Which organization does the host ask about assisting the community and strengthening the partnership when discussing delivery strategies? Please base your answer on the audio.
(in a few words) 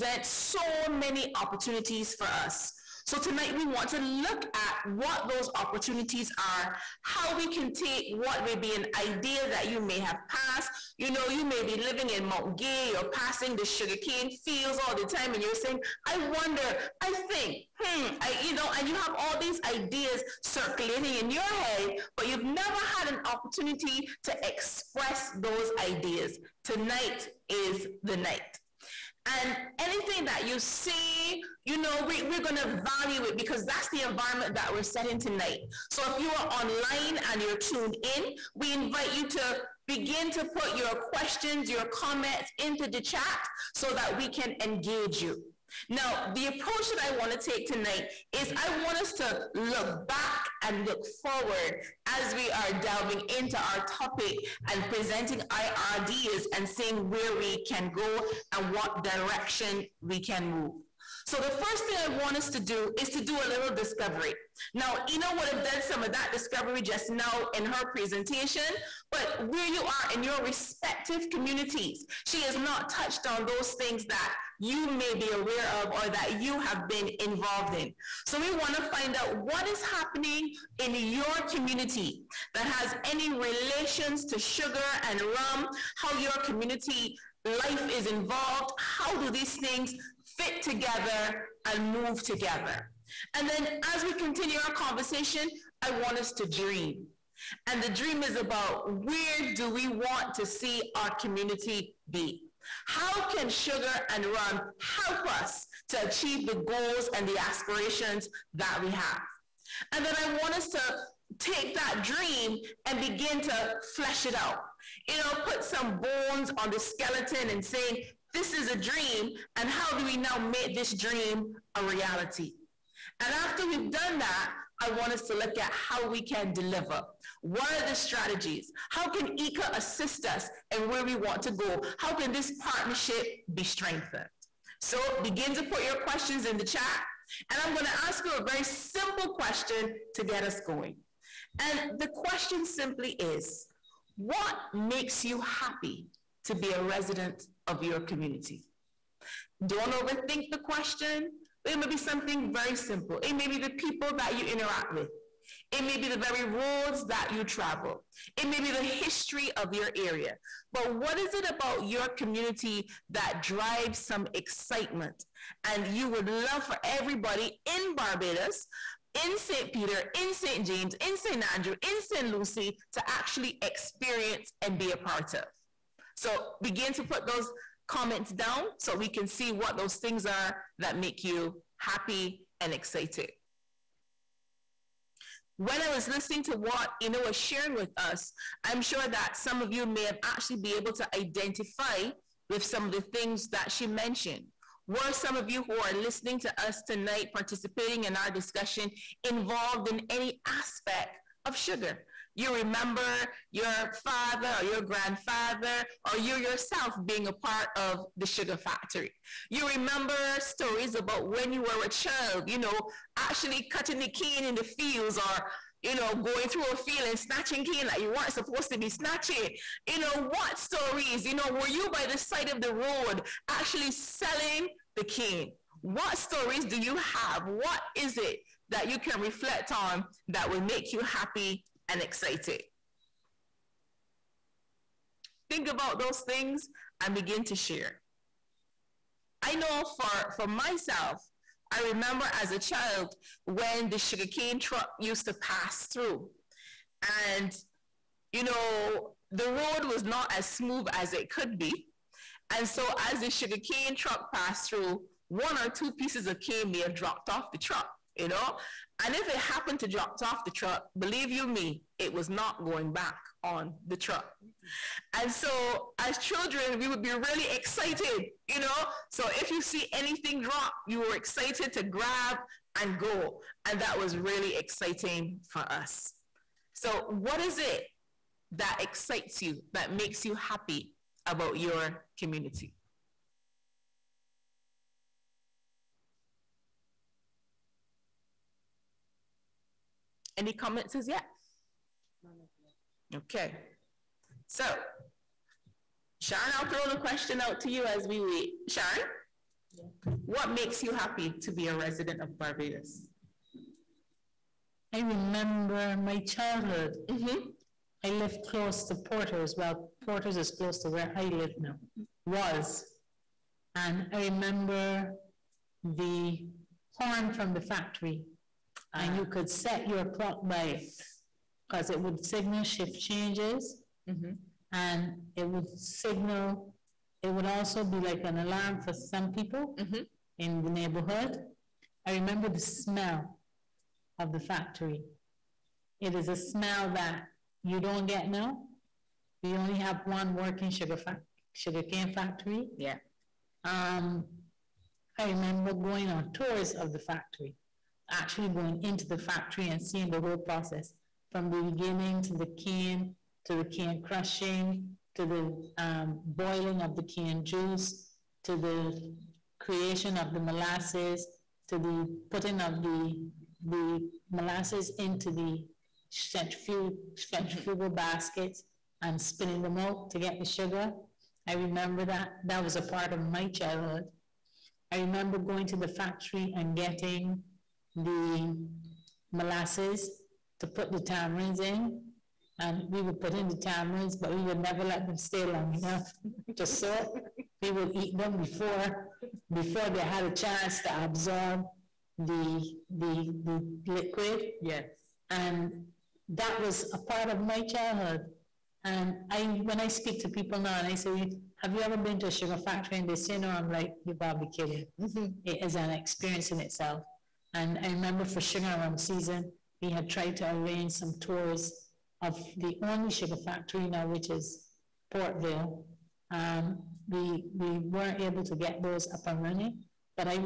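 IICA.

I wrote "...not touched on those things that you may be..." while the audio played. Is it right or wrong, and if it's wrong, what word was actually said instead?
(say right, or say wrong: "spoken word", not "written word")
right.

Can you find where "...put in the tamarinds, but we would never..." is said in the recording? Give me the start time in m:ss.
6:23.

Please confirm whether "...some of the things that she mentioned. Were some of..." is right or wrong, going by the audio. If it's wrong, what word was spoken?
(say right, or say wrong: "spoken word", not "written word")
right.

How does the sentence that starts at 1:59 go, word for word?
And how do we now make this dream a reality?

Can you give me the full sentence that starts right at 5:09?
Well, Porters is close to where I live now, was.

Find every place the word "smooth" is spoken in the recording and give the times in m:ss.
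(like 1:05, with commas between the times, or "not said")
4:10.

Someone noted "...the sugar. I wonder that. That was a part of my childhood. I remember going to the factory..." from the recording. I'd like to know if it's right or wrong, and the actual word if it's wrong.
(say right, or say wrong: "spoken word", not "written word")
wrong: "remember", not "wonder".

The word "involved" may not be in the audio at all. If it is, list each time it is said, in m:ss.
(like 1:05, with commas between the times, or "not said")
1:17, 1:28, 3:19.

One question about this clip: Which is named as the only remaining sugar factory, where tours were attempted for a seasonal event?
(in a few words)
Portvale.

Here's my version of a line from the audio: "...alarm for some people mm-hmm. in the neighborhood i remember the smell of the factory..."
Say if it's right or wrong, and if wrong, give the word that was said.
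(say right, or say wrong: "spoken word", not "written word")
right.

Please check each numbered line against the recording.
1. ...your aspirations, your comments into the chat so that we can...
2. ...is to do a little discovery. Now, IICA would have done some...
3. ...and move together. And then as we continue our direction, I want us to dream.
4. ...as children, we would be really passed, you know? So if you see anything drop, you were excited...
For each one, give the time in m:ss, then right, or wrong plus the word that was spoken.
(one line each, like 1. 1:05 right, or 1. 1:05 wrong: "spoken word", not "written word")
1. 0:40 wrong: "questions", not "aspirations"
2. 1:02 wrong: "Ena", not "IICA"
3. 1:31 wrong: "conversation", not "direction"
4. 4:25 wrong: "excited", not "passed".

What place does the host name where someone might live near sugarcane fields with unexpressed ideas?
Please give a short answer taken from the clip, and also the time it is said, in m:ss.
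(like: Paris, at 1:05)
Mount Gay, at 0:12.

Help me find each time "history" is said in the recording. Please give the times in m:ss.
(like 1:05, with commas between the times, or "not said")
2:38.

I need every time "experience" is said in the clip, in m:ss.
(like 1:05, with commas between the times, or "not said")
2:53, 6:45.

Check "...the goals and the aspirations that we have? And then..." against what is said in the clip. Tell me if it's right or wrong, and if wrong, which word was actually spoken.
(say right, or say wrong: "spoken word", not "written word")
right.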